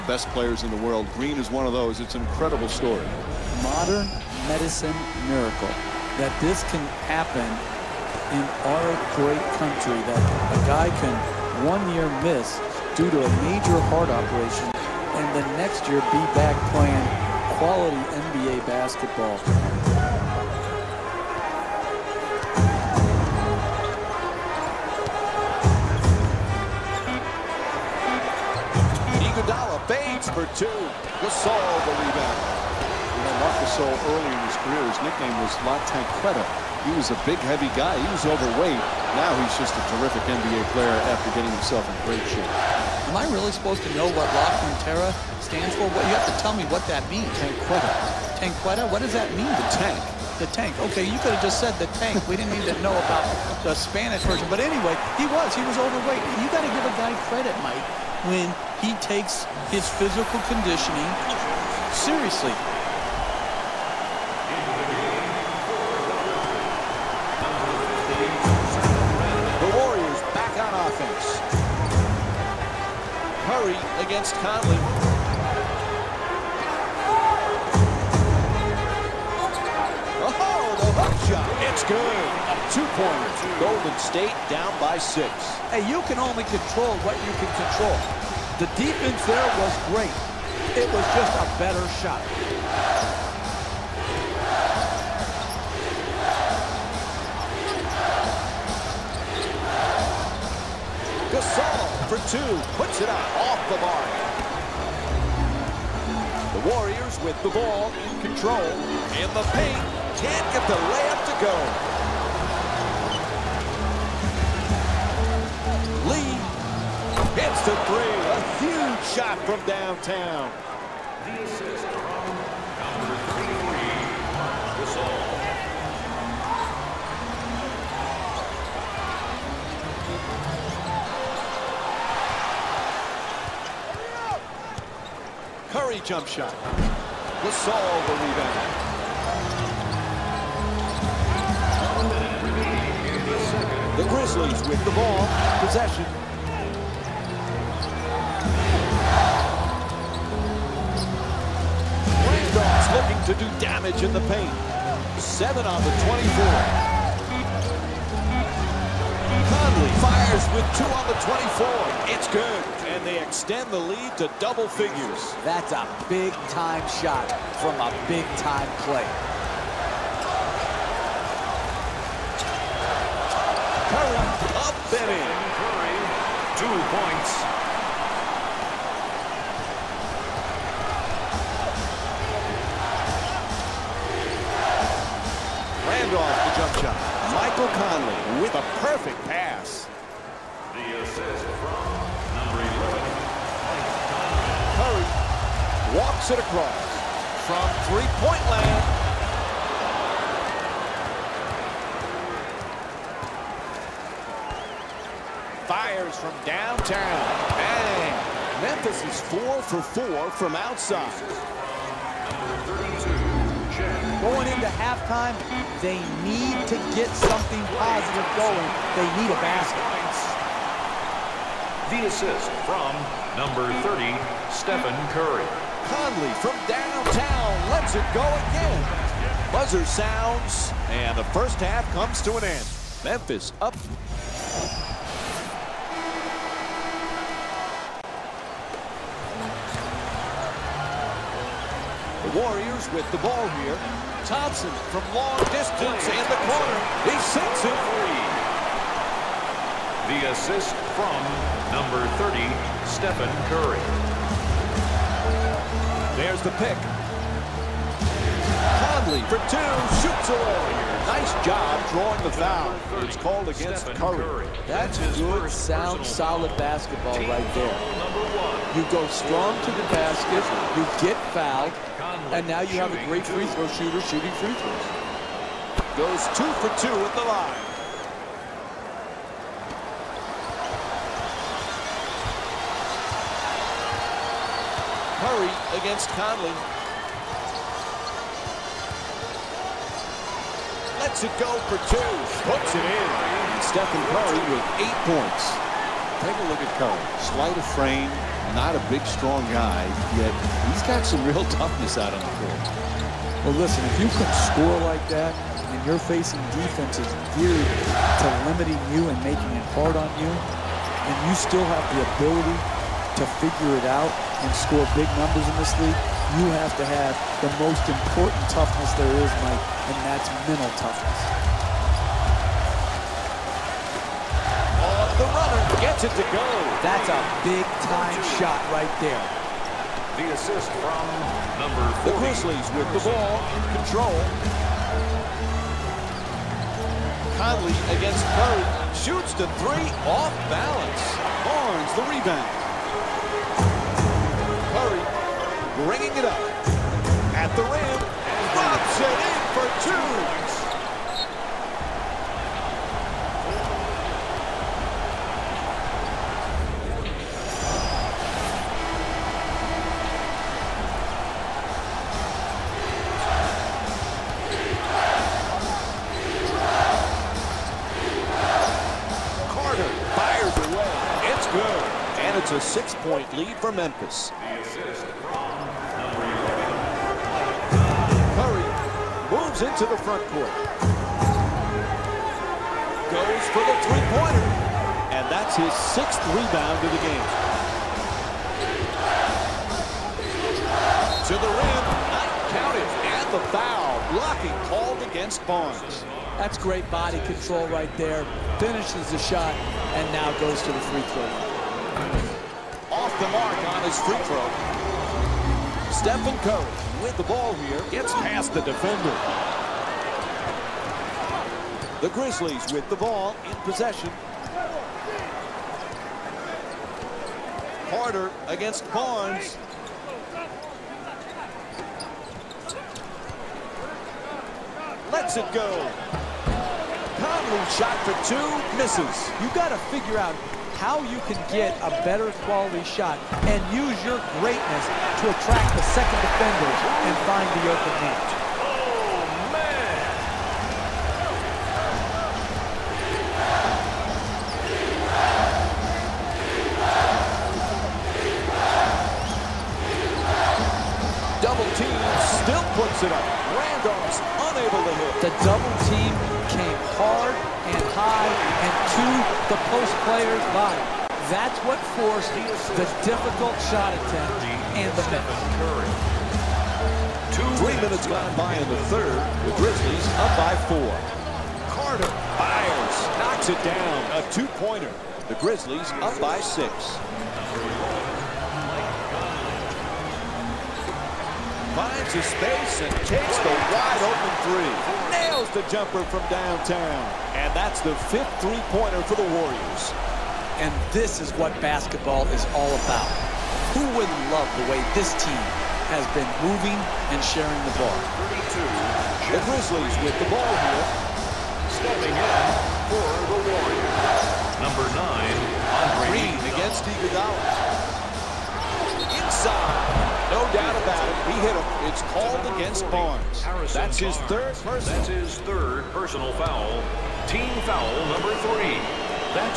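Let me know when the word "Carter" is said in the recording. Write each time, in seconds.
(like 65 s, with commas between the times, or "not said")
369 s, 417 s, 471 s.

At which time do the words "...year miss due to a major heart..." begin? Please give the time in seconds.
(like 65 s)
11 s.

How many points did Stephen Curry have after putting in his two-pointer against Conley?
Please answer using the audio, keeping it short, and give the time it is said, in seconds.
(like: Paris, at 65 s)
8, at 294 s.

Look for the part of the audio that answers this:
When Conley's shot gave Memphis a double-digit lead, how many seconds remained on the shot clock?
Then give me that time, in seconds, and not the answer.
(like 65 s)
160 s.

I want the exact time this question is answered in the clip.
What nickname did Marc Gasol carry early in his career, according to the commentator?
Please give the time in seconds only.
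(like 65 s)
35 s.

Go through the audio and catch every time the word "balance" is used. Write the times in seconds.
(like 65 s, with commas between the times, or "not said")
340 s.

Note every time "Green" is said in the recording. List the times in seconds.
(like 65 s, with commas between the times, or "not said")
1 s, 506 s.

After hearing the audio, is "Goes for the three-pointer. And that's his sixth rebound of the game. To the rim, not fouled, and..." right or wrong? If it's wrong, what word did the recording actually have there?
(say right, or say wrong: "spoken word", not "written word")
wrong: "counted", not "fouled".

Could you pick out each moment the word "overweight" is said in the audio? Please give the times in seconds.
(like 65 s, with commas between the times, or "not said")
38 s, 55 s.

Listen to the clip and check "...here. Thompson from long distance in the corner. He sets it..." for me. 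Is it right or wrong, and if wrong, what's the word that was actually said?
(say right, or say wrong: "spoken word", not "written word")
right.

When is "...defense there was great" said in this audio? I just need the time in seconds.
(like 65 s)
88 s.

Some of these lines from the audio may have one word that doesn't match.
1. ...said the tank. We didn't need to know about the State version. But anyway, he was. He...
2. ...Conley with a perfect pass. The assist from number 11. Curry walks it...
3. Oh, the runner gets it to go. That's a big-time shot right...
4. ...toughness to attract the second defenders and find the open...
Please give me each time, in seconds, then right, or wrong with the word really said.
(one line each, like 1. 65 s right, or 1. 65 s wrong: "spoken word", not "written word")
1. 51 s wrong: "Spanish", not "State"
2. 187 s right
3. 324 s right
4. 434 s wrong: "greatness", not "toughness".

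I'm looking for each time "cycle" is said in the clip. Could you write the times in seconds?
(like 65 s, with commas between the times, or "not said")
not said.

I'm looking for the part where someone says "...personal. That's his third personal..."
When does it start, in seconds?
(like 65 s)
514 s.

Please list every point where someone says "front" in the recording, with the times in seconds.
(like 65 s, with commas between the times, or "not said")
380 s.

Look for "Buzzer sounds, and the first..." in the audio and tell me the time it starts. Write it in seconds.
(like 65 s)
229 s.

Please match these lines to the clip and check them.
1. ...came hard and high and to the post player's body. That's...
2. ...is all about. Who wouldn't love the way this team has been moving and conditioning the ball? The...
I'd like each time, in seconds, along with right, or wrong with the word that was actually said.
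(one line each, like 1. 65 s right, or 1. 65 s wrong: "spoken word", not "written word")
1. 456 s right
2. 492 s wrong: "sharing", not "conditioning".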